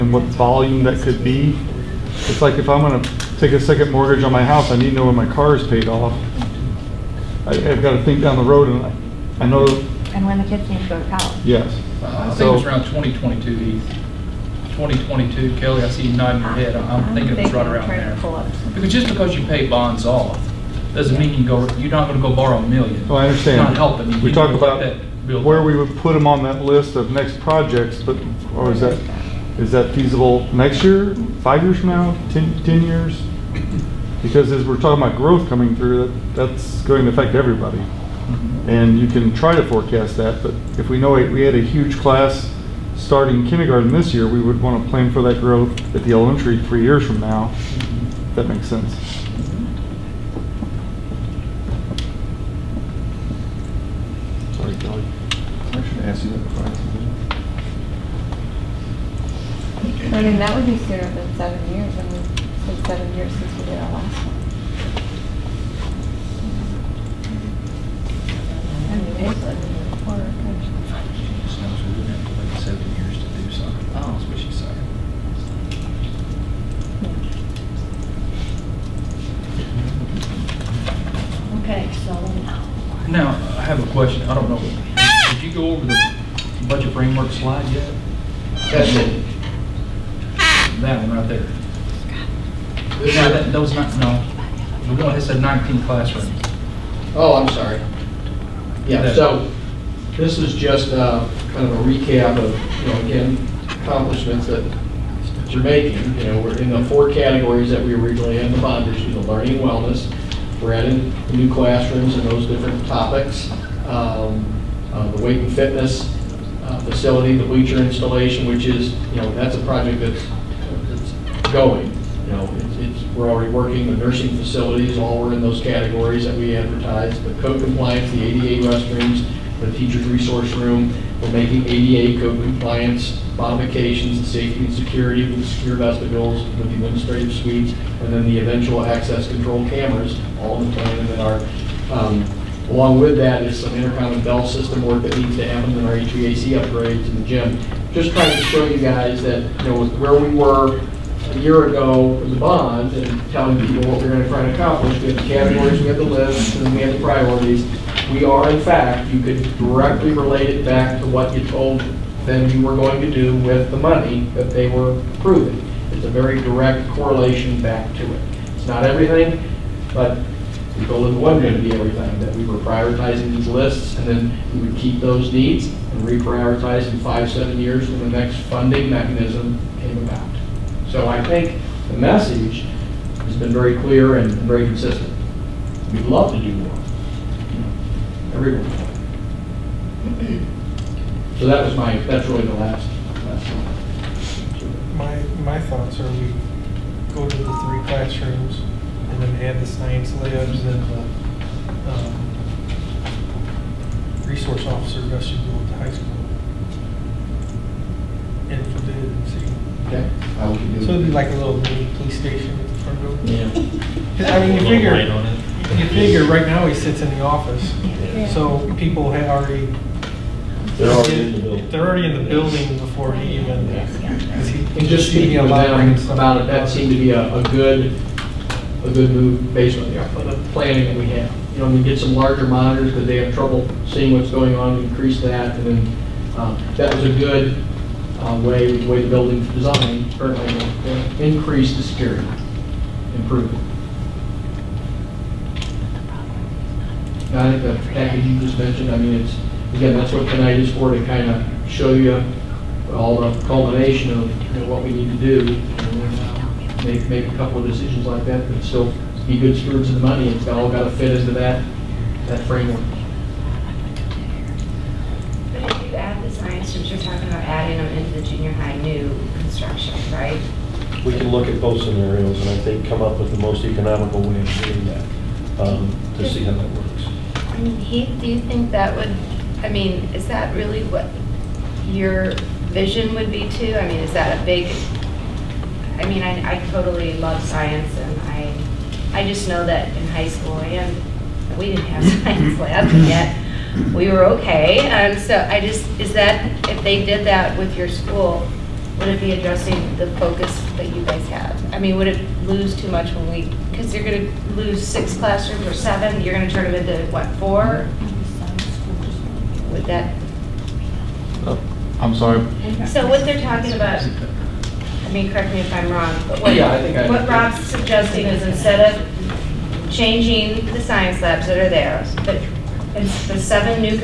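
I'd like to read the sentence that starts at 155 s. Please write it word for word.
We have the categories, we had the lists, and we had the priorities.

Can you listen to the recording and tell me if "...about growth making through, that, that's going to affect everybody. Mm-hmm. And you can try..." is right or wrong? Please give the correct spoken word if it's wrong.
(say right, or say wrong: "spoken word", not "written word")
wrong: "coming", not "making".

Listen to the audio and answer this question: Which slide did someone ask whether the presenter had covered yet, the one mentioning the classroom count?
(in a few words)
budget framework.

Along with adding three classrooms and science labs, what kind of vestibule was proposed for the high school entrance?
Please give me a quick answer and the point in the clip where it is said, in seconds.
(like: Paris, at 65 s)
resource officer vestibule, at 204 s.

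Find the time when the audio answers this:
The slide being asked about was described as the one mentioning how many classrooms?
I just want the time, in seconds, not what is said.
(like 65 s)
95 s.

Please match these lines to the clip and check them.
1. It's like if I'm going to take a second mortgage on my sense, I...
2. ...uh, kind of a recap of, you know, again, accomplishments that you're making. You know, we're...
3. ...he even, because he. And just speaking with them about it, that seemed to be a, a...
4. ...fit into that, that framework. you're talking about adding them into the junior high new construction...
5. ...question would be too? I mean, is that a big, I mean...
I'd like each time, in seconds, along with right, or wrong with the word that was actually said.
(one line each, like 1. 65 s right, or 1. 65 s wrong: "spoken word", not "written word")
1. 2 s wrong: "house", not "sense"
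2. 100 s right
3. 223 s right
4. 260 s right
5. 282 s wrong: "vision", not "question".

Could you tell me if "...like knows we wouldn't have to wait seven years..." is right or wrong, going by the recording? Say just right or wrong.
right.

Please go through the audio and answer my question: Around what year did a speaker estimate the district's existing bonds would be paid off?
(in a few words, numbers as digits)
2022.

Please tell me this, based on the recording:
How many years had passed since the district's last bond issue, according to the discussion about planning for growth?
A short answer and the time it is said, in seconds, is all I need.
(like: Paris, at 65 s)
7, at 62 s.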